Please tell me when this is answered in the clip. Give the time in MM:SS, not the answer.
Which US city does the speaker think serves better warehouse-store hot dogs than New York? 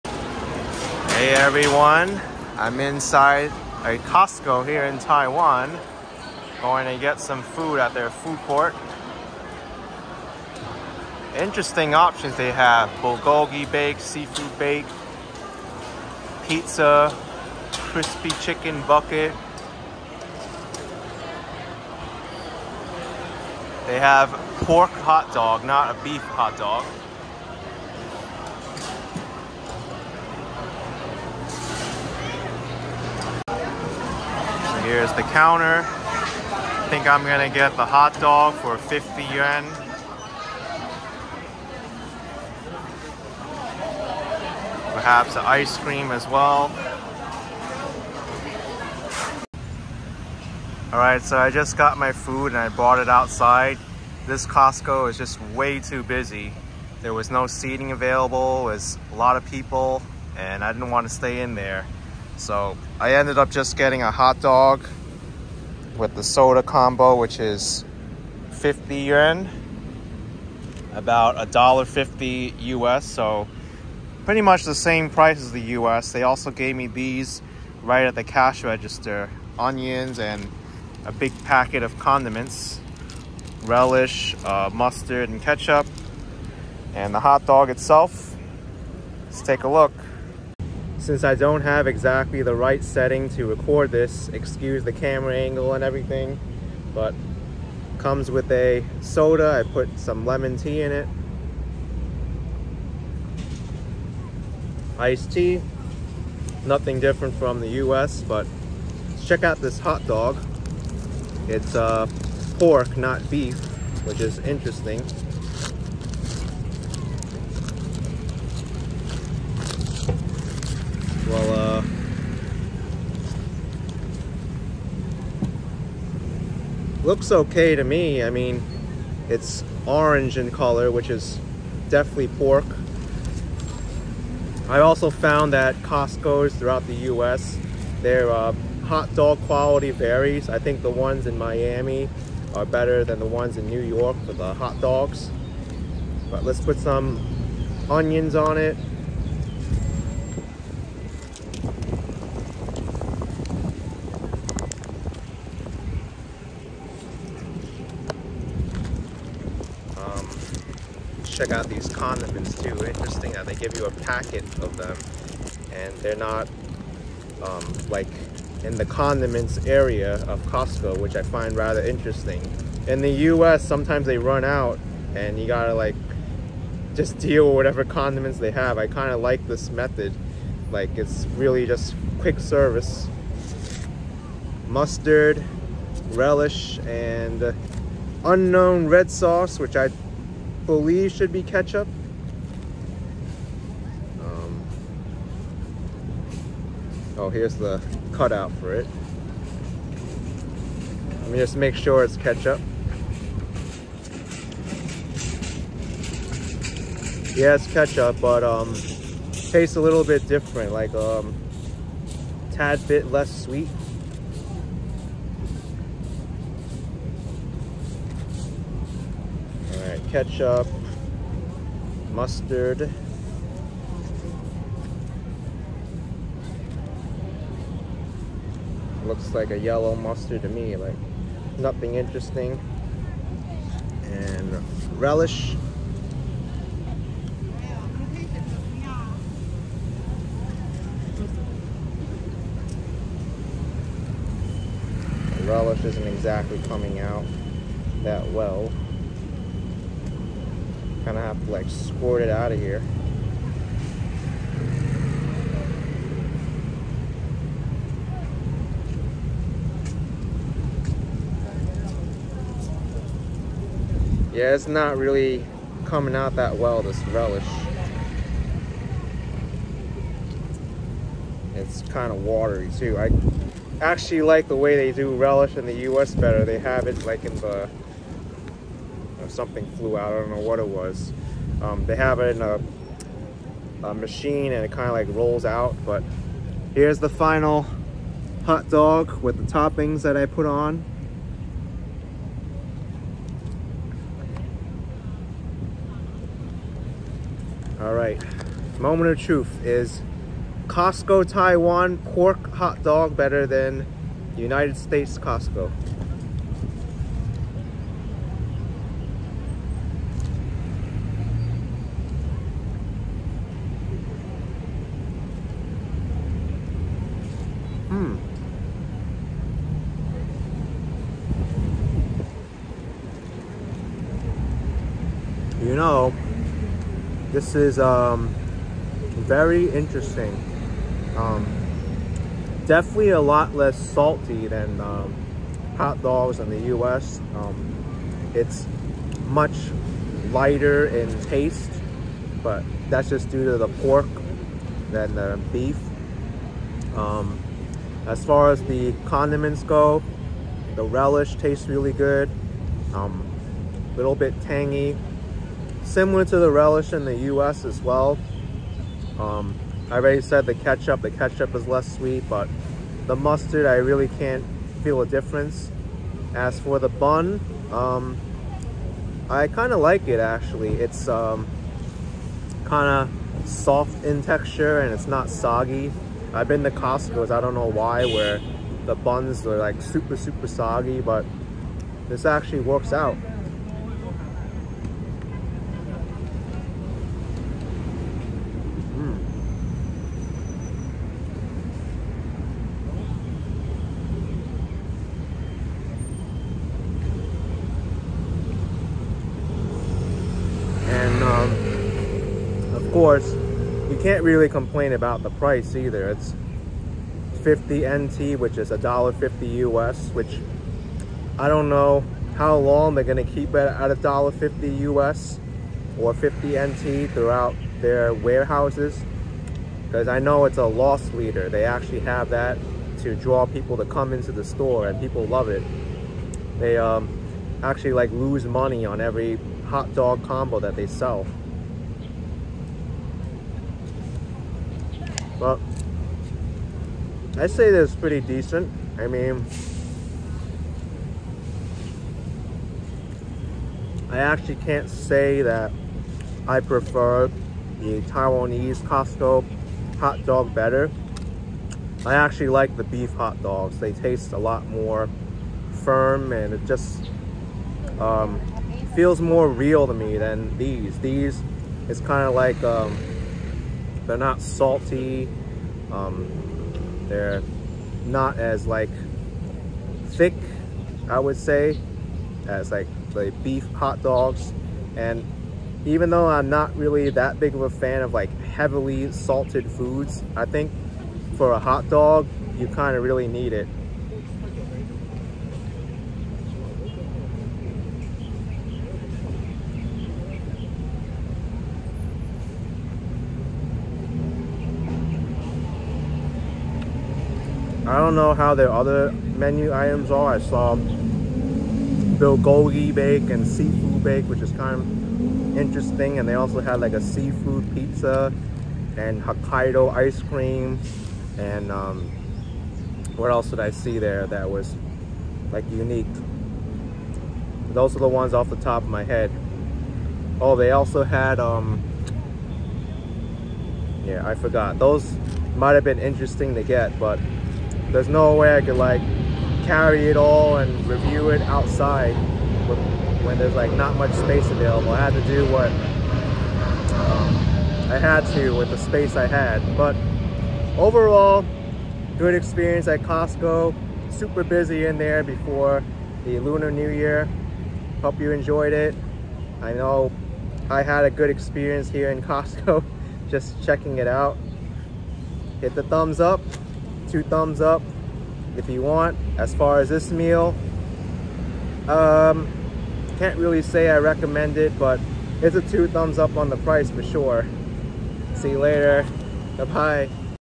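02:20.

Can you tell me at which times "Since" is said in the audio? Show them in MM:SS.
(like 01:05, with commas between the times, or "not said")
01:31.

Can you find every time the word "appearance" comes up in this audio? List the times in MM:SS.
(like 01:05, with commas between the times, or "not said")
not said.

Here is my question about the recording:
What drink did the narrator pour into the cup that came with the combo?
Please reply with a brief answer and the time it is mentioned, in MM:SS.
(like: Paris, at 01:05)
lemon tea, at 01:39.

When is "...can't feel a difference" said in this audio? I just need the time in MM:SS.
06:04.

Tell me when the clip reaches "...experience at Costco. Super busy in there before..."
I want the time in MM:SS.
09:02.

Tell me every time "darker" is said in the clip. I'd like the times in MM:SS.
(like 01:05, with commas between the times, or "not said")
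not said.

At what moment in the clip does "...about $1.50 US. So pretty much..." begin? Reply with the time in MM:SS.
01:10.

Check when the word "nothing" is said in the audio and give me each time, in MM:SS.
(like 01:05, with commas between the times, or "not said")
01:46, 03:51.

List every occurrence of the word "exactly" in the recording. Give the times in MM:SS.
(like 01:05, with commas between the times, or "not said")
01:31, 04:06.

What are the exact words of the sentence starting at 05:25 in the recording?
you know, this is um, very interesting.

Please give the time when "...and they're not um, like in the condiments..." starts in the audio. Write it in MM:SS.
02:45.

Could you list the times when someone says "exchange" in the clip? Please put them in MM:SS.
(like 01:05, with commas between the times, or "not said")
not said.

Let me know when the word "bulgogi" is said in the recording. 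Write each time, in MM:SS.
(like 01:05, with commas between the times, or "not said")
00:13, 08:20.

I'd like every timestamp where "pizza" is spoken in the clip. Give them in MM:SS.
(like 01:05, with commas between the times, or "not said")
00:16, 08:27.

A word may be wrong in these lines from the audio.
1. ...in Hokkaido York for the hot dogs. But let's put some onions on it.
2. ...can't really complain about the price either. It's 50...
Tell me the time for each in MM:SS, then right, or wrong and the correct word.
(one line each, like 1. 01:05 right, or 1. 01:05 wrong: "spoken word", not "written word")
1. 02:23 wrong: "New", not "Hokkaido"
2. 06:44 right.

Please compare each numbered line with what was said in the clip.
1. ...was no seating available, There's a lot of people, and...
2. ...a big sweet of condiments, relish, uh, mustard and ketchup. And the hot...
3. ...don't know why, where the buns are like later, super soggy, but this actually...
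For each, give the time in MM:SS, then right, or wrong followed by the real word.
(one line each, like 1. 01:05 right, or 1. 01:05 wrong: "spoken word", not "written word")
1. 00:57 right
2. 01:21 wrong: "packet", not "sweet"
3. 06:17 wrong: "super", not "later".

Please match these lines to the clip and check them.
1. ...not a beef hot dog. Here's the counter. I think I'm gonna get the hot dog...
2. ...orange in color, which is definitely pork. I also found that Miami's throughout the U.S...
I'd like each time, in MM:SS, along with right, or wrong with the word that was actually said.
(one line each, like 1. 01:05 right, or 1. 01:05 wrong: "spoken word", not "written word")
1. 00:25 right
2. 02:09 wrong: "Costco", not "Miami".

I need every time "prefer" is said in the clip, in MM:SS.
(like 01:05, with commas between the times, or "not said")
07:26.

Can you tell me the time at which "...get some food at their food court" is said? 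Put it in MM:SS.
00:06.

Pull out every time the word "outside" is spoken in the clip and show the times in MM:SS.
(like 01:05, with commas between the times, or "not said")
00:53, 08:51.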